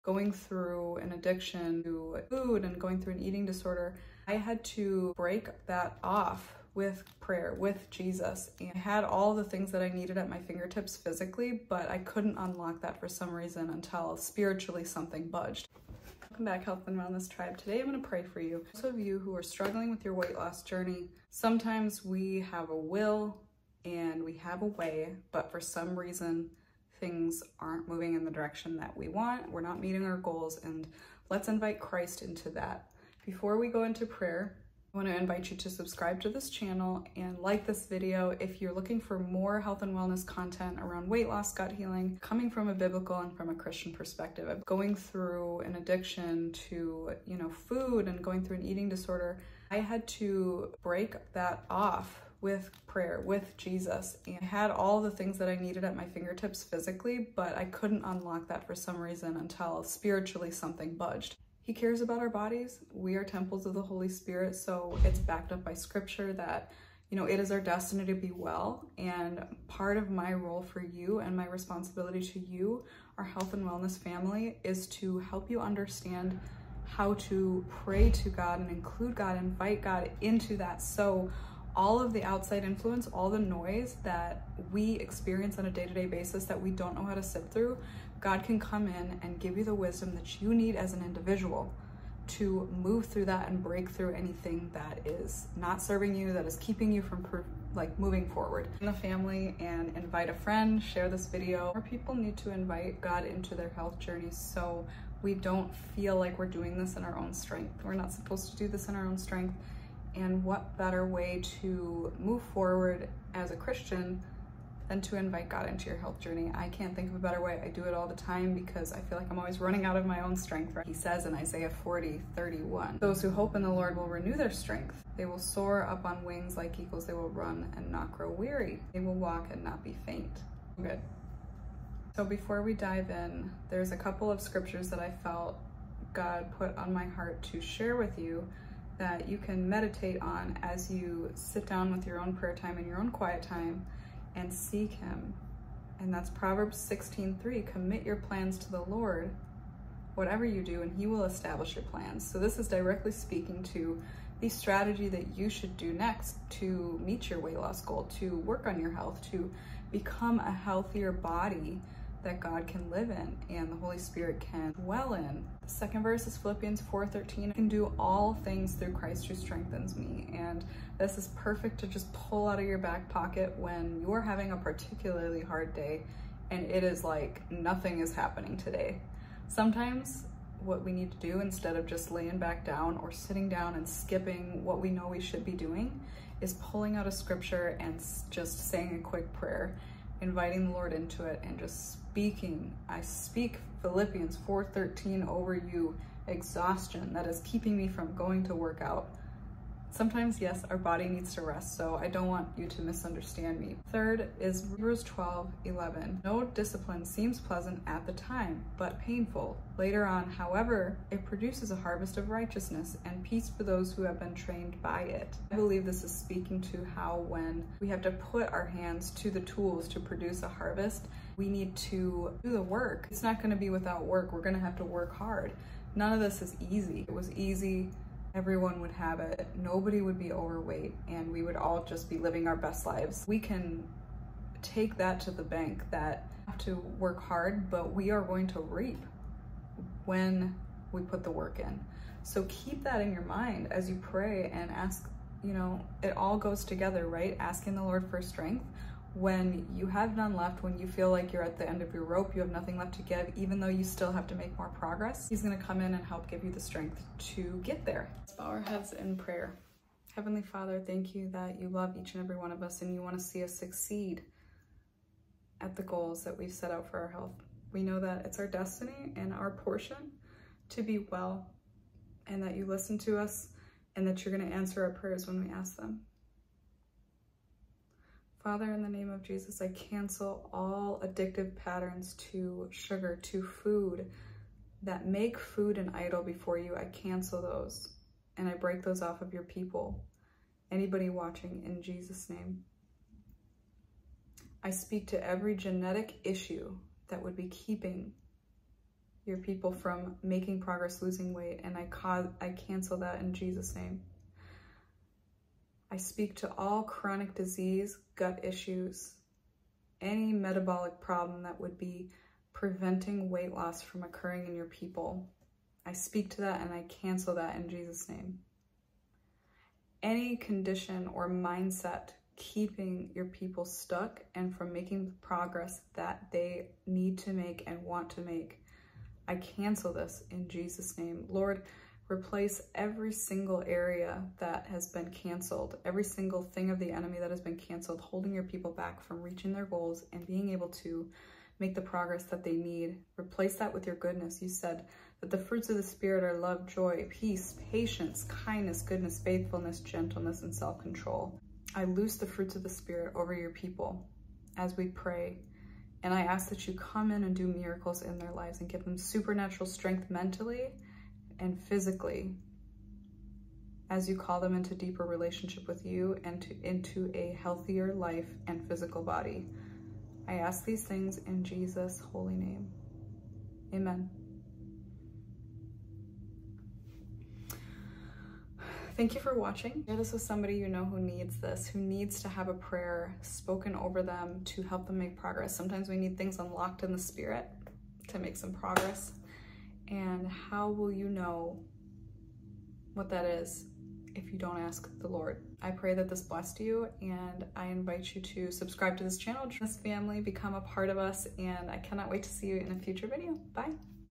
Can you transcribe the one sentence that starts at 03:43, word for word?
It's not gonna be without work.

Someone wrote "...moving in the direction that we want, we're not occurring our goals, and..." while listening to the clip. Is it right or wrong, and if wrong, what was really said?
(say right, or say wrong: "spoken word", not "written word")
wrong: "meeting", not "occurring".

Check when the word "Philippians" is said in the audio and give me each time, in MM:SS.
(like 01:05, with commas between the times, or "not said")
02:46, 03:13.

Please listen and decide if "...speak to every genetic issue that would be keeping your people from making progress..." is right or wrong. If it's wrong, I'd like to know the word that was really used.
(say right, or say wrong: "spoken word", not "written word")
right.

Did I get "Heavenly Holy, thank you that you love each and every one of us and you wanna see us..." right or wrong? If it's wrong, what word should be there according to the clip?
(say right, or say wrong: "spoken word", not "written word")
wrong: "Father", not "Holy".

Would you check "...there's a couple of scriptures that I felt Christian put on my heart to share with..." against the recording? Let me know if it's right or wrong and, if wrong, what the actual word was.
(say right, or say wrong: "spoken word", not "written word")
wrong: "God", not "Christian".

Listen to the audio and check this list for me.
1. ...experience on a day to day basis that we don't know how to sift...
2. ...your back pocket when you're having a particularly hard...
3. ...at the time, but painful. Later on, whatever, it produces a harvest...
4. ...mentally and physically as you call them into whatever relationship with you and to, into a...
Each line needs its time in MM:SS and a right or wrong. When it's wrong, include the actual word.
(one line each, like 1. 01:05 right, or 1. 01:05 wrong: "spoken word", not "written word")
1. 01:24 right
2. 02:52 right
3. 03:27 wrong: "however", not "whatever"
4. 06:00 wrong: "deeper", not "whatever".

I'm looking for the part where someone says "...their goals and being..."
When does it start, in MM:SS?
05:39.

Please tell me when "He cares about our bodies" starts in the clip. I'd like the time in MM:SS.
01:01.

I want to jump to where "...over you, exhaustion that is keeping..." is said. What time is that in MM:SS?
03:15.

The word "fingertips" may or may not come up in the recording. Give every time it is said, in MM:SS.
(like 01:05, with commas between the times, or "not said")
00:10, 00:56.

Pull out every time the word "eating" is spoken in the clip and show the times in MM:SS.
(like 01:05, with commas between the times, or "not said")
00:03, 00:48.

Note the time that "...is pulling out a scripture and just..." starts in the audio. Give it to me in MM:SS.
03:06.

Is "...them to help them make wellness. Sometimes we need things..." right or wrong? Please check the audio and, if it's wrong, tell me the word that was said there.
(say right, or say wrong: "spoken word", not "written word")
wrong: "progress", not "wellness".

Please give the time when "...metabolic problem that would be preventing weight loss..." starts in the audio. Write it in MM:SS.
05:10.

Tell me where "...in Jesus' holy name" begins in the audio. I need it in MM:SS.
06:11.